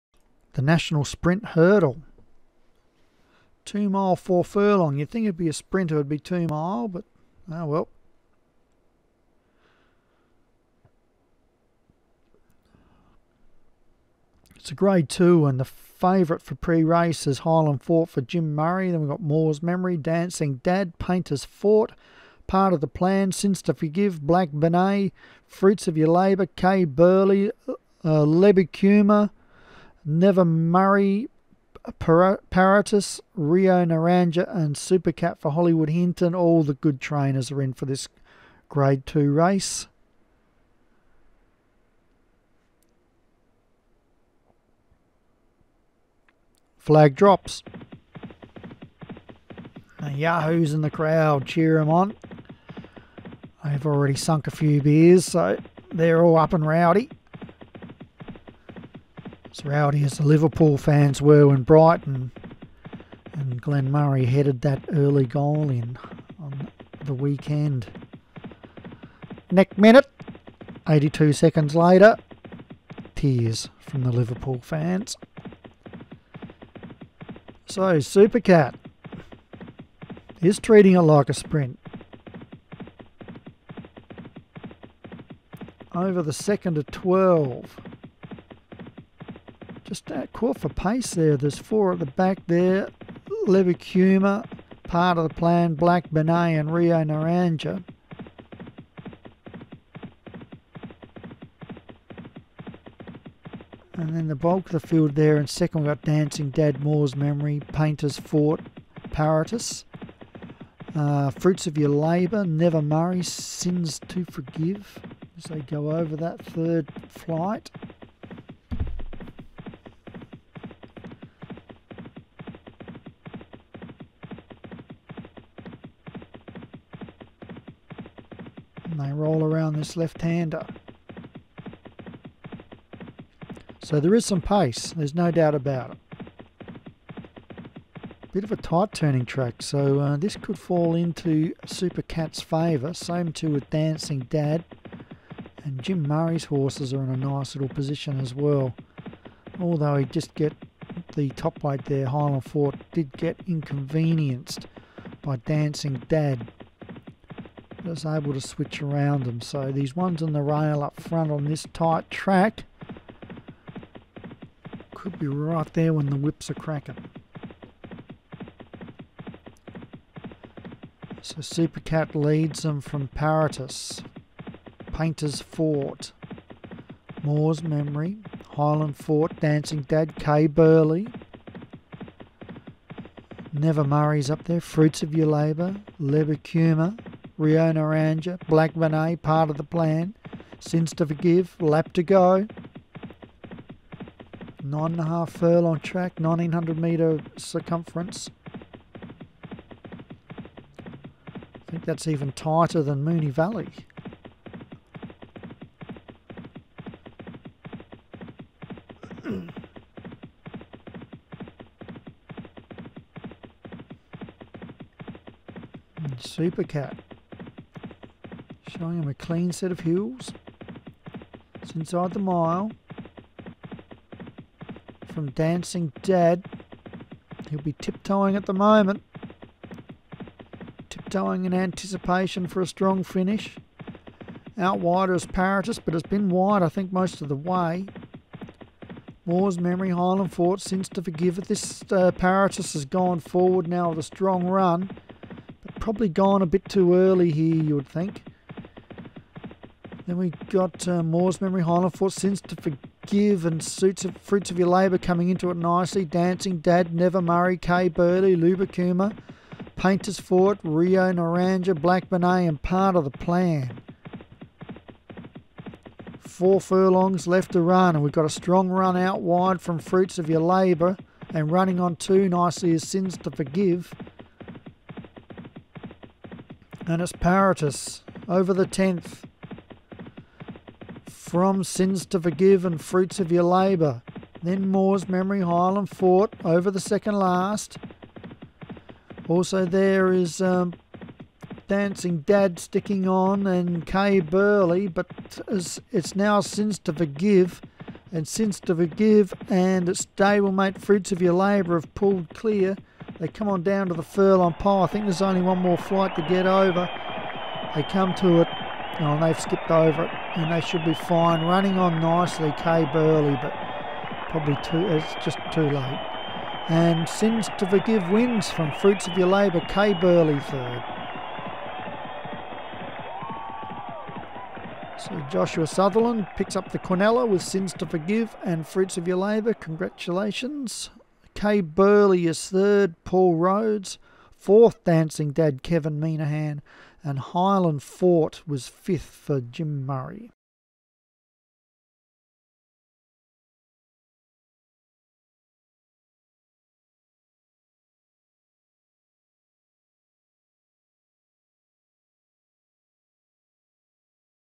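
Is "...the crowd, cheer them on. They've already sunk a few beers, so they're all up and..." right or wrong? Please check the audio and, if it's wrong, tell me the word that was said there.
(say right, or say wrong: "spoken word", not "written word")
right.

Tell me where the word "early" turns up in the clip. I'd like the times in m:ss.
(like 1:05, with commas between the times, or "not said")
1:04, 4:06.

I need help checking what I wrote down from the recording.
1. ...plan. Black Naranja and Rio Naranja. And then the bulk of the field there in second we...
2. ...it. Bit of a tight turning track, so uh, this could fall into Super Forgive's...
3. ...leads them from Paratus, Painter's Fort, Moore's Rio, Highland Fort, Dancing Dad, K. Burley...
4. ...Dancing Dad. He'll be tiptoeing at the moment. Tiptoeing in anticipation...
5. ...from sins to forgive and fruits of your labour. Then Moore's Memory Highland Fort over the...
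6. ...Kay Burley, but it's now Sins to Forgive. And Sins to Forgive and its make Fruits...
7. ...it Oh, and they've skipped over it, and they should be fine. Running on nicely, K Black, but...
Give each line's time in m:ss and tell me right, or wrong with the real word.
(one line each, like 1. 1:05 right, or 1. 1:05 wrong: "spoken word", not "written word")
1. 1:35 wrong: "Benet", not "Naranja"
2. 2:15 wrong: "Cat", not "Forgive"
3. 2:52 wrong: "Memory", not "Rio"
4. 3:45 right
5. 4:41 right
6. 4:53 right
7. 5:08 wrong: "Burley", not "Black".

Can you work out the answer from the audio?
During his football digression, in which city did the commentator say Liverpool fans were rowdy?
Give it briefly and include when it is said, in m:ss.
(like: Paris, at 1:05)
Brighton, at 1:01.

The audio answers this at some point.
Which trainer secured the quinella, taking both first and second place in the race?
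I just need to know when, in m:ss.
5:25.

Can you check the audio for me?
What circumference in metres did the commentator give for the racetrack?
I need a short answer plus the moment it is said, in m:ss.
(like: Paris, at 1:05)
1900, at 3:16.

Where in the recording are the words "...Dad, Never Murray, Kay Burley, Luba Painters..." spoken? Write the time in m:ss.
4:16.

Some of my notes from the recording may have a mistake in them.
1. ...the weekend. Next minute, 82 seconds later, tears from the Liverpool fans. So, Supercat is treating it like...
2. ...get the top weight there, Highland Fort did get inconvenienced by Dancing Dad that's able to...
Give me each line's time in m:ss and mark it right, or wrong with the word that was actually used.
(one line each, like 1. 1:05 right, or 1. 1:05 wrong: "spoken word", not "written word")
1. 1:07 right
2. 2:30 right.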